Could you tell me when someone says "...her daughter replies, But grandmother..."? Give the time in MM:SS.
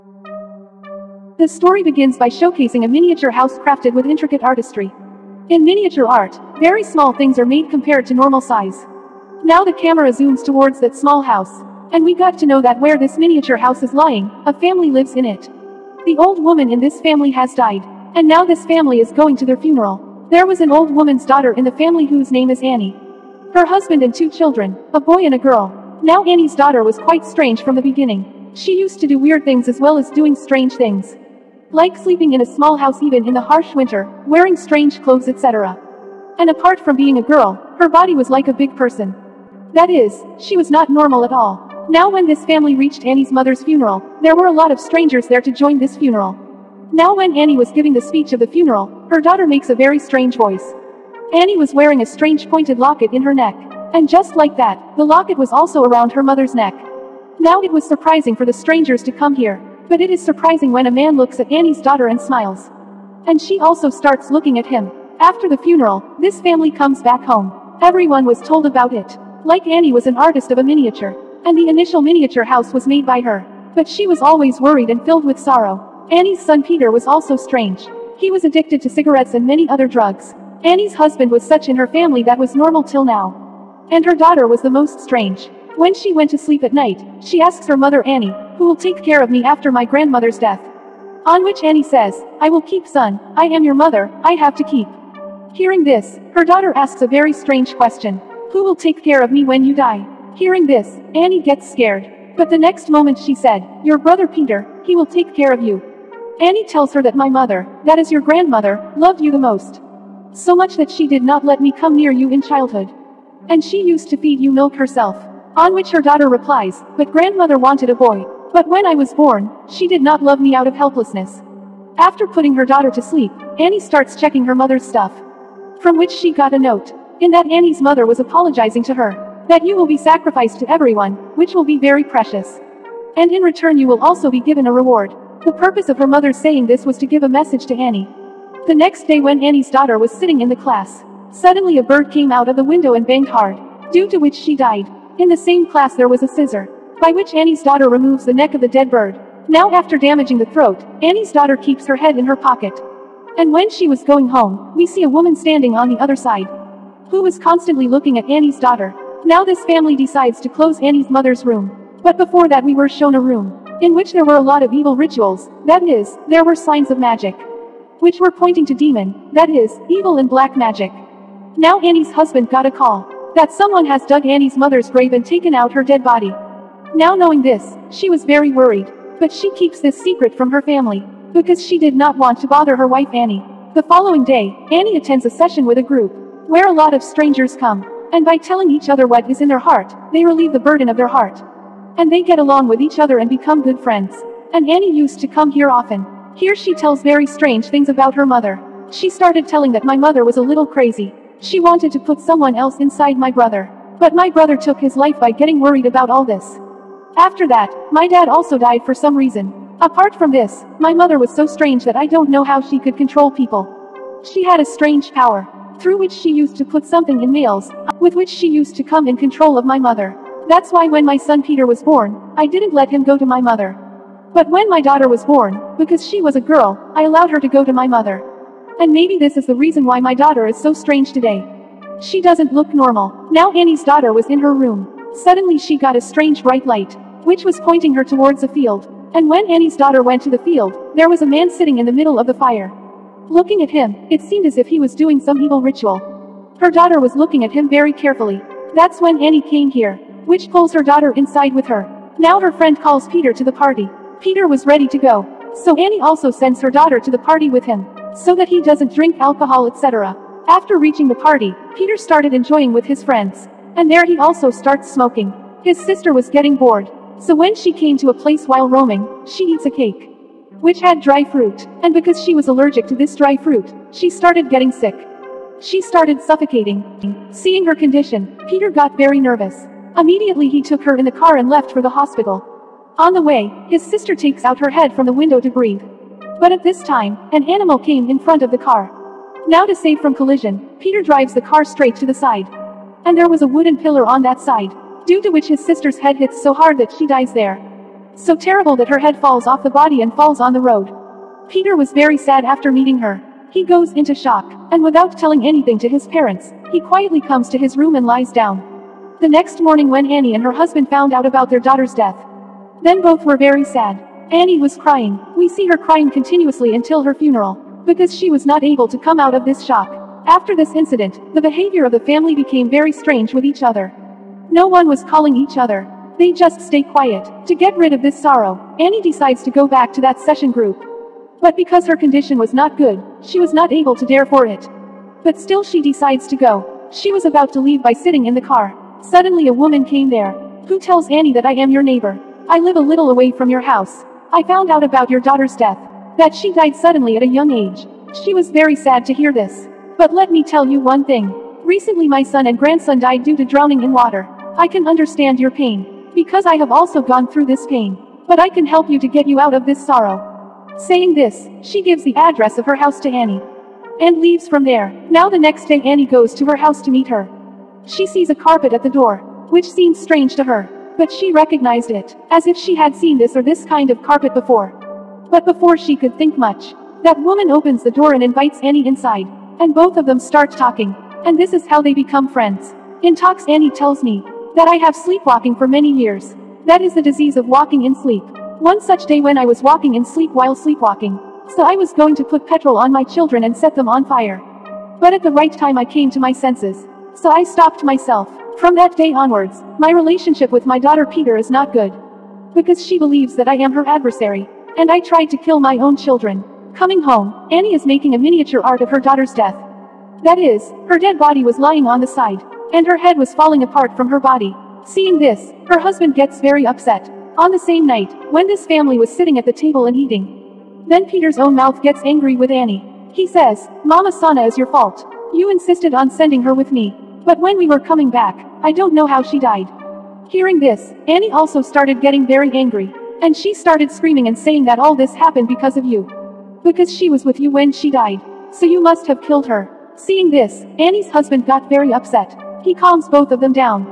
01:55.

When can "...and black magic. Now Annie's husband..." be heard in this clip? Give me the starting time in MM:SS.
02:50.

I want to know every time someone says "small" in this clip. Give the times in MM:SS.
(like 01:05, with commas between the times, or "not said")
00:06, 00:10, 00:32.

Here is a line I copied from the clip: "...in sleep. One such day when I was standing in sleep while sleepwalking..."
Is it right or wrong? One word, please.
wrong.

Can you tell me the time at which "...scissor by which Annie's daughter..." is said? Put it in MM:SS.
02:26.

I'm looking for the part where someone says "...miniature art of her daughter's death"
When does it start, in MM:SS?
06:48.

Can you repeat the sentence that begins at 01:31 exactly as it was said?
On which Annie says, I will keep son, I am your mother, I have to keep.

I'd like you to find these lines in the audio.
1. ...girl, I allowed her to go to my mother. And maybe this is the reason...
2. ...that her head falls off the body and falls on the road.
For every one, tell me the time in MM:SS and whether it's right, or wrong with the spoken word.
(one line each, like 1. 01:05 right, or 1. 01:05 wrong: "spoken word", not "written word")
1. 03:46 right
2. 04:58 right.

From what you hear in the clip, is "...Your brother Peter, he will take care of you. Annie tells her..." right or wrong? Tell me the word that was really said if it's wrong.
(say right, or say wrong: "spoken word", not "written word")
right.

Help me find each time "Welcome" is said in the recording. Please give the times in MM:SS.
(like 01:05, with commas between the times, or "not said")
not said.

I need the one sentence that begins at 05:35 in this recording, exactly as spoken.
But still she decides to go.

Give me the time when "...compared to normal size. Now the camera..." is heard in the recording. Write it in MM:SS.
00:07.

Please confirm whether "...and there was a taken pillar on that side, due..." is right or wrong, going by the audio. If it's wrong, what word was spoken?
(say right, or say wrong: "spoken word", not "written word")
wrong: "wooden", not "taken".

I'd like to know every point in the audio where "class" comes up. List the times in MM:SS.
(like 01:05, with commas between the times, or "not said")
02:20, 02:25.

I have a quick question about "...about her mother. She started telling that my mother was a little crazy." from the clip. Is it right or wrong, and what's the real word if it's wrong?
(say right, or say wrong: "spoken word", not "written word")
right.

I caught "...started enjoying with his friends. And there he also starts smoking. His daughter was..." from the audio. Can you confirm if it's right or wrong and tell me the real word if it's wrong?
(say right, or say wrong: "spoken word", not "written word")
wrong: "sister", not "daughter".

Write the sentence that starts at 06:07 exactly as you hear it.
She sees a carpet at the door, which seems strange to her.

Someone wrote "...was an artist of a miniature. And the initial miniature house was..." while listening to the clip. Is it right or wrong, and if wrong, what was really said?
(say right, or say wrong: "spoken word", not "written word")
right.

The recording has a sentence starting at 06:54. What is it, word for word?
Seeing this, her husband gets very upset.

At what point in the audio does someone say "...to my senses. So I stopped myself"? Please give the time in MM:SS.
06:36.